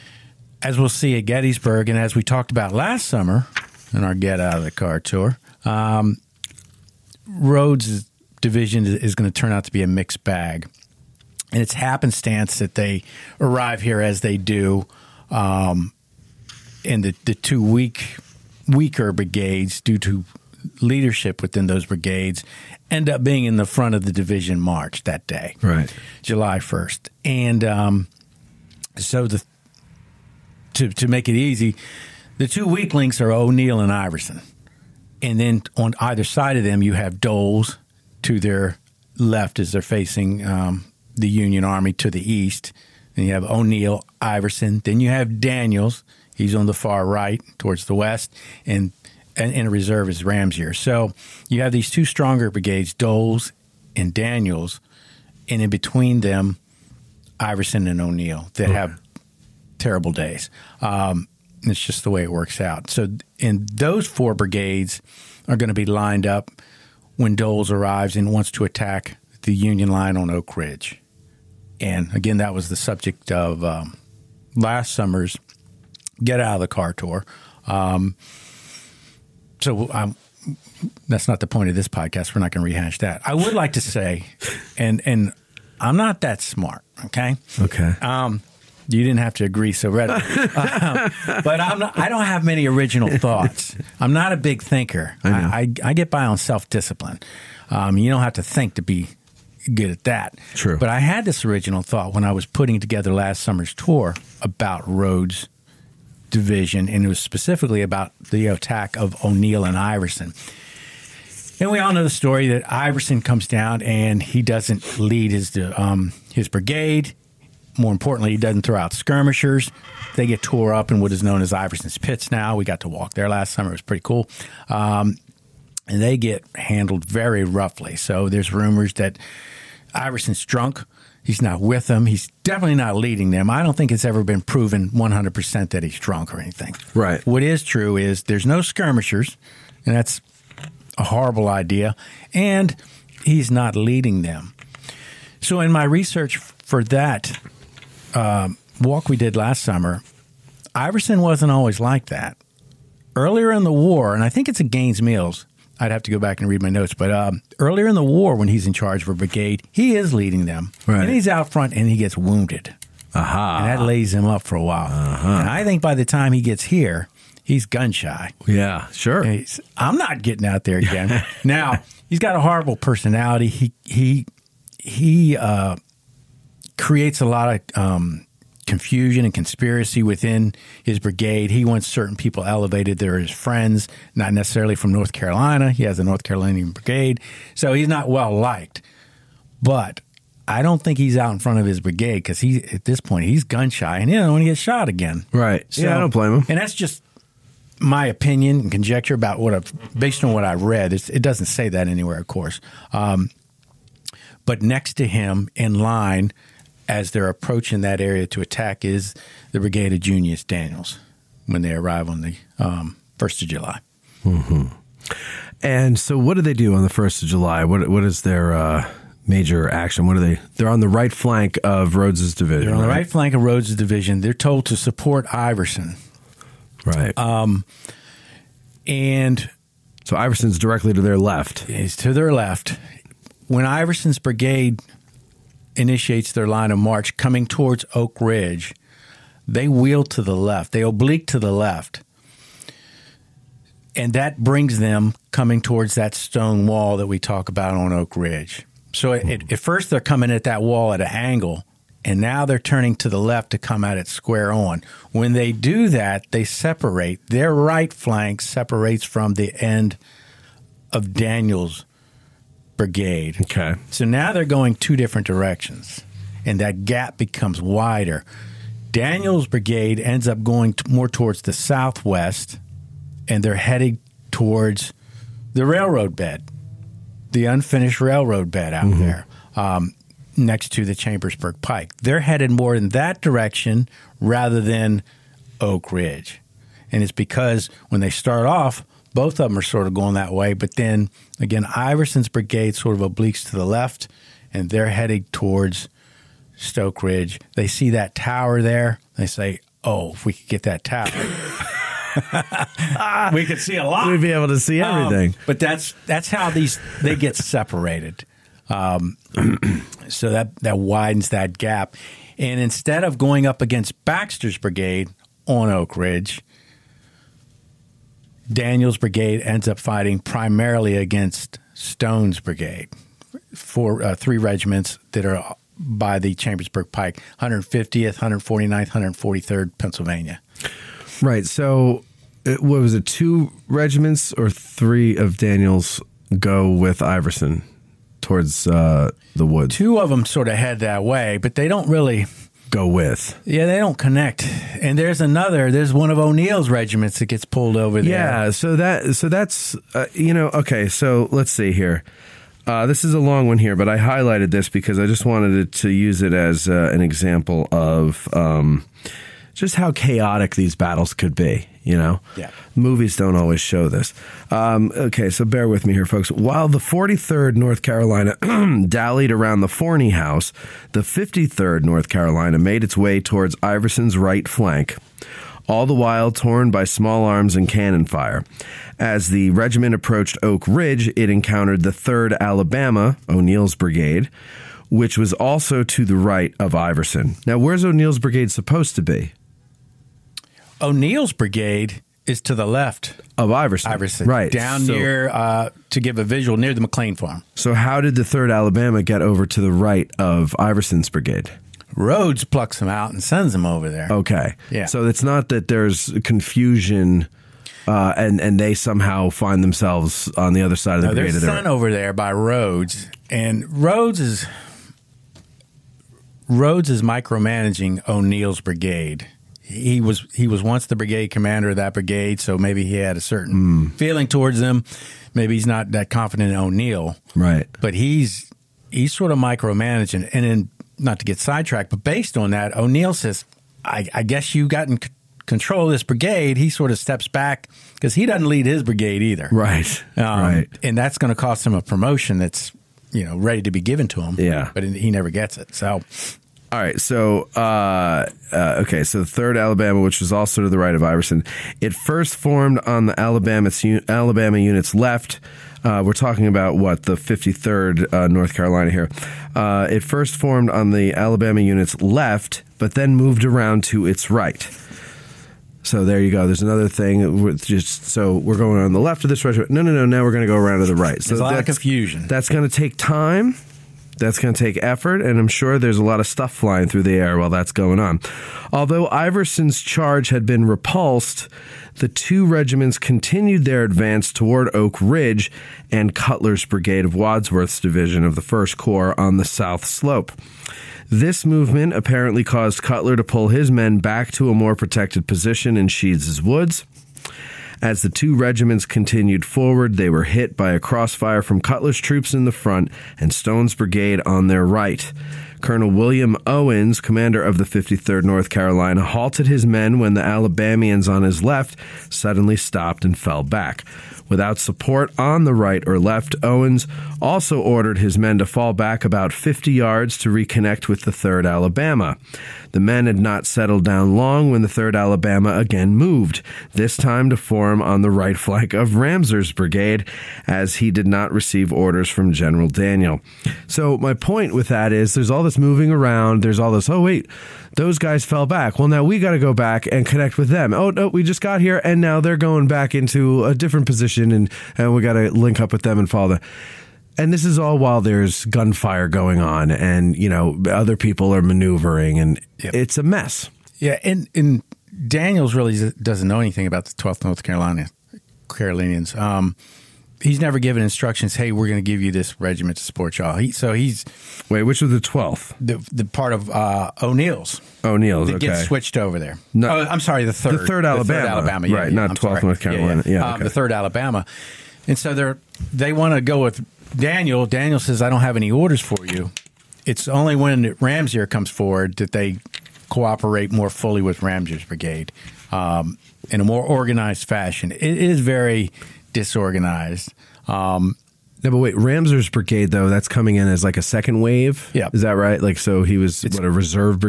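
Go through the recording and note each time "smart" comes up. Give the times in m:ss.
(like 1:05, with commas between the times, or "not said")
1:26.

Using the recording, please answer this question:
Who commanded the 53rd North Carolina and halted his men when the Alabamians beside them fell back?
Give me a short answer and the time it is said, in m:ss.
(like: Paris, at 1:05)
William Owens, at 8:25.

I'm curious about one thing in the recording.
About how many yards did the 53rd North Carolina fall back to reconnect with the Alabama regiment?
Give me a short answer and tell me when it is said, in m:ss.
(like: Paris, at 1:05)
50 yards, at 8:39.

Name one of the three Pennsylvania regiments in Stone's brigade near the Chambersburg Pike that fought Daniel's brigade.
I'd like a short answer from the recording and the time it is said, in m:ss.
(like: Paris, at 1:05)
150th Pennsylvania, at 5:27.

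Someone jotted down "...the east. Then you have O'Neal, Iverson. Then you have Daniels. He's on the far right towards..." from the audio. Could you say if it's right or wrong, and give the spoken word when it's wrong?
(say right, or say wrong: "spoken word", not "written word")
right.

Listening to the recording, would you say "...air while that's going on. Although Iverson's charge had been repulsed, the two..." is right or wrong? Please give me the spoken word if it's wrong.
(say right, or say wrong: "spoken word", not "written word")
right.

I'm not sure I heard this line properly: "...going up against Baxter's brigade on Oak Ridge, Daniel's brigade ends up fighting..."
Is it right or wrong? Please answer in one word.
right.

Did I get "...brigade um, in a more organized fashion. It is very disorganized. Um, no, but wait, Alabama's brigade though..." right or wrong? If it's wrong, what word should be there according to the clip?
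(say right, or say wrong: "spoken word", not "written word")
wrong: "Ramseur", not "Alabama".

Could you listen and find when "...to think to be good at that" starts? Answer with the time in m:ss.
1:38.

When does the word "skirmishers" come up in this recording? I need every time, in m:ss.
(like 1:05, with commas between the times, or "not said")
1:58, 2:18.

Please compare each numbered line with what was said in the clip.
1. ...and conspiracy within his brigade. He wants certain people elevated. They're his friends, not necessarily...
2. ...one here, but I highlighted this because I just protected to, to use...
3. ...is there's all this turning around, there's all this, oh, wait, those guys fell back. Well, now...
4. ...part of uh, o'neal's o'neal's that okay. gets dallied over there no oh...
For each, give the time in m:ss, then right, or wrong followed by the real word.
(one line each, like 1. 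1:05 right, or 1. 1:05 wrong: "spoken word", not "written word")
1. 2:59 right
2. 5:53 wrong: "wanted", not "protected"
3. 8:54 wrong: "moving", not "turning"
4. 9:26 wrong: "switched", not "dallied".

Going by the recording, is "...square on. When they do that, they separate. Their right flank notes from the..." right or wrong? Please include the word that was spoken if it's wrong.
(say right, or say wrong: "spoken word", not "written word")
wrong: "separates", not "notes".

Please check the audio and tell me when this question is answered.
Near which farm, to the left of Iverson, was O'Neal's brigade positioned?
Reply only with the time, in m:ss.
6:36.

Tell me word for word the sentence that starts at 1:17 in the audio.
Um, so um, that's not the point of this podcast.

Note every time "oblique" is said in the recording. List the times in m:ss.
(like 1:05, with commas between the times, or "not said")
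4:00, 4:53.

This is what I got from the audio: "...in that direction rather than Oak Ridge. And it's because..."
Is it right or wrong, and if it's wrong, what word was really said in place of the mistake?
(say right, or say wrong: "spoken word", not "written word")
right.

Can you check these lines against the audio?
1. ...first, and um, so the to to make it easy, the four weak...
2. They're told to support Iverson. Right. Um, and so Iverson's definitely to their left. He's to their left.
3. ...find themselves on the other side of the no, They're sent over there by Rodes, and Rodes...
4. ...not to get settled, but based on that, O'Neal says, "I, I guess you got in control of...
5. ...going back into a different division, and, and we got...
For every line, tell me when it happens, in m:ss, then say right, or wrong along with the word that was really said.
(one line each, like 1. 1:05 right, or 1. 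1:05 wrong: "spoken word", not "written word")
1. 0:26 wrong: "two", not "four"
2. 3:44 wrong: "directly", not "definitely"
3. 6:49 right
4. 7:10 wrong: "sidetracked", not "settled"
5. 9:02 wrong: "position", not "division".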